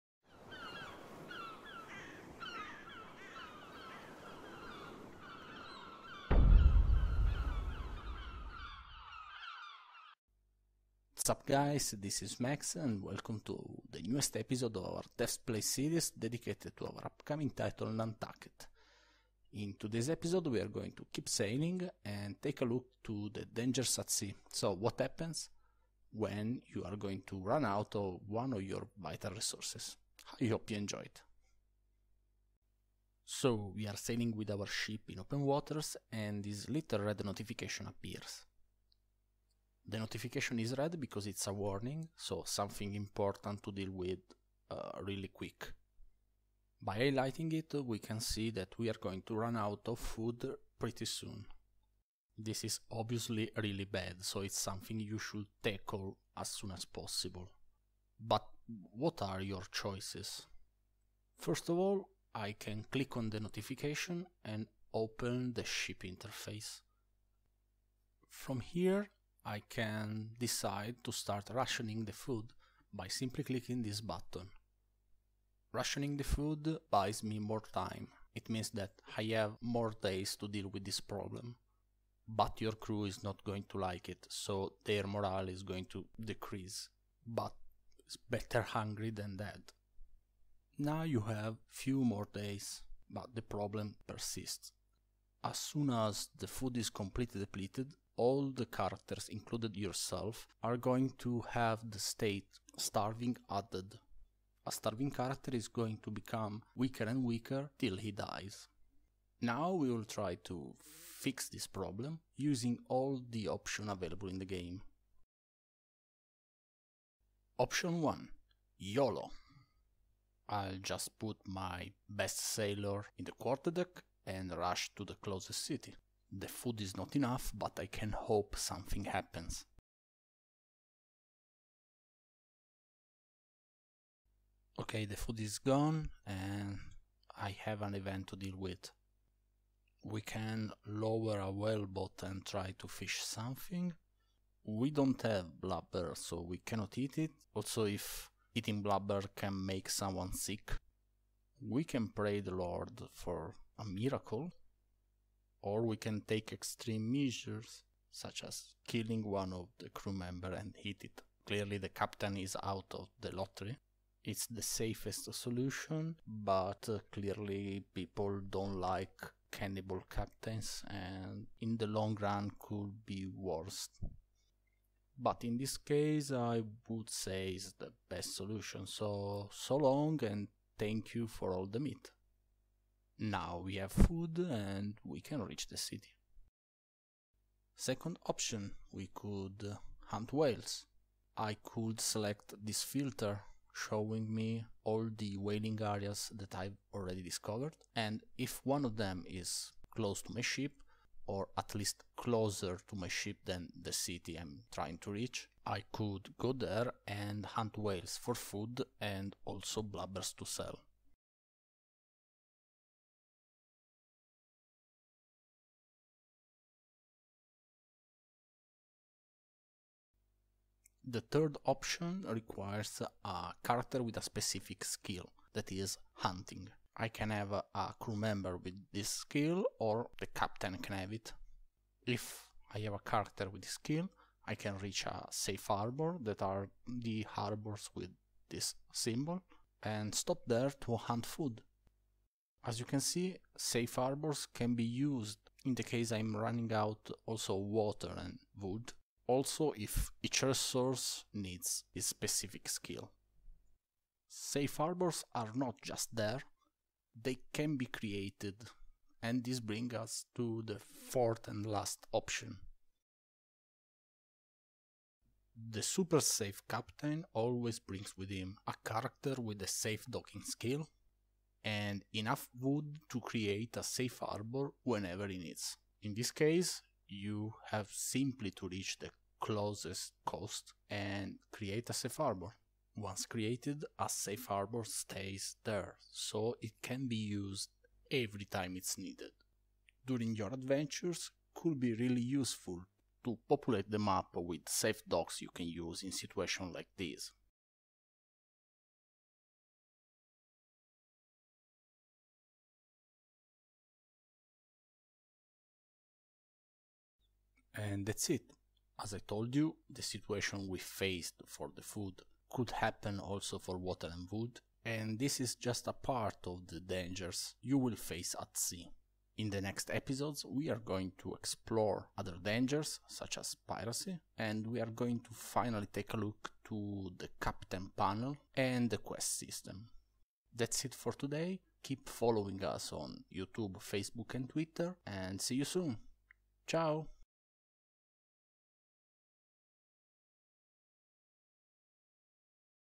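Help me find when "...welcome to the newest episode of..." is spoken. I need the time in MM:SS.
00:13.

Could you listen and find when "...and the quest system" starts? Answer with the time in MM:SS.
05:28.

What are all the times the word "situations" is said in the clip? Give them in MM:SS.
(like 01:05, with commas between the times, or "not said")
04:56, 05:10.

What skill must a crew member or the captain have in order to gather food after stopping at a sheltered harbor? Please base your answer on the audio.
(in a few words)
Hunting.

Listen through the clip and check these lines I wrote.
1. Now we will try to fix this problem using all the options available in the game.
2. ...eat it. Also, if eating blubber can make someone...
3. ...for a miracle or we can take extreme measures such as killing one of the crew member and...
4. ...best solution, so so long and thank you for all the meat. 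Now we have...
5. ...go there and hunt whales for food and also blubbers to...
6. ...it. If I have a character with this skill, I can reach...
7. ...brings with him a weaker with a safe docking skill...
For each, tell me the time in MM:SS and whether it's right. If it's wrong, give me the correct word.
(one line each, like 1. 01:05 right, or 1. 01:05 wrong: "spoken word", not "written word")
1. 01:49 right
2. 02:26 right
3. 02:33 right
4. 02:58 right
5. 03:26 right
6. 03:51 right
7. 04:27 wrong: "character", not "weaker".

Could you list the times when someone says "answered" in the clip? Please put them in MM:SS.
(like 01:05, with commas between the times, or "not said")
not said.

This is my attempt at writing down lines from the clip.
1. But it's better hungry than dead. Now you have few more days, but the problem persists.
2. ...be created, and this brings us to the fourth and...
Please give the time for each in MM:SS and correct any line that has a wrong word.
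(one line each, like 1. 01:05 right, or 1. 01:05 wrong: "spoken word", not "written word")
1. 01:27 right
2. 04:17 right.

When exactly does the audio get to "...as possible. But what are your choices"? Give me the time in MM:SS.
00:56.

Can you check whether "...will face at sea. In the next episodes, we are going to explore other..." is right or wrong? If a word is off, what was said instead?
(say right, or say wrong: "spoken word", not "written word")
right.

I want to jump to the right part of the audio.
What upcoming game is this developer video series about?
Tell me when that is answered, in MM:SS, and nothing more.
00:17.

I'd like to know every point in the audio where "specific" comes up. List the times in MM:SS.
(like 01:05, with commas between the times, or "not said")
03:44, 04:12.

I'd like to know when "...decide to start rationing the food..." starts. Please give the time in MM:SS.
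01:10.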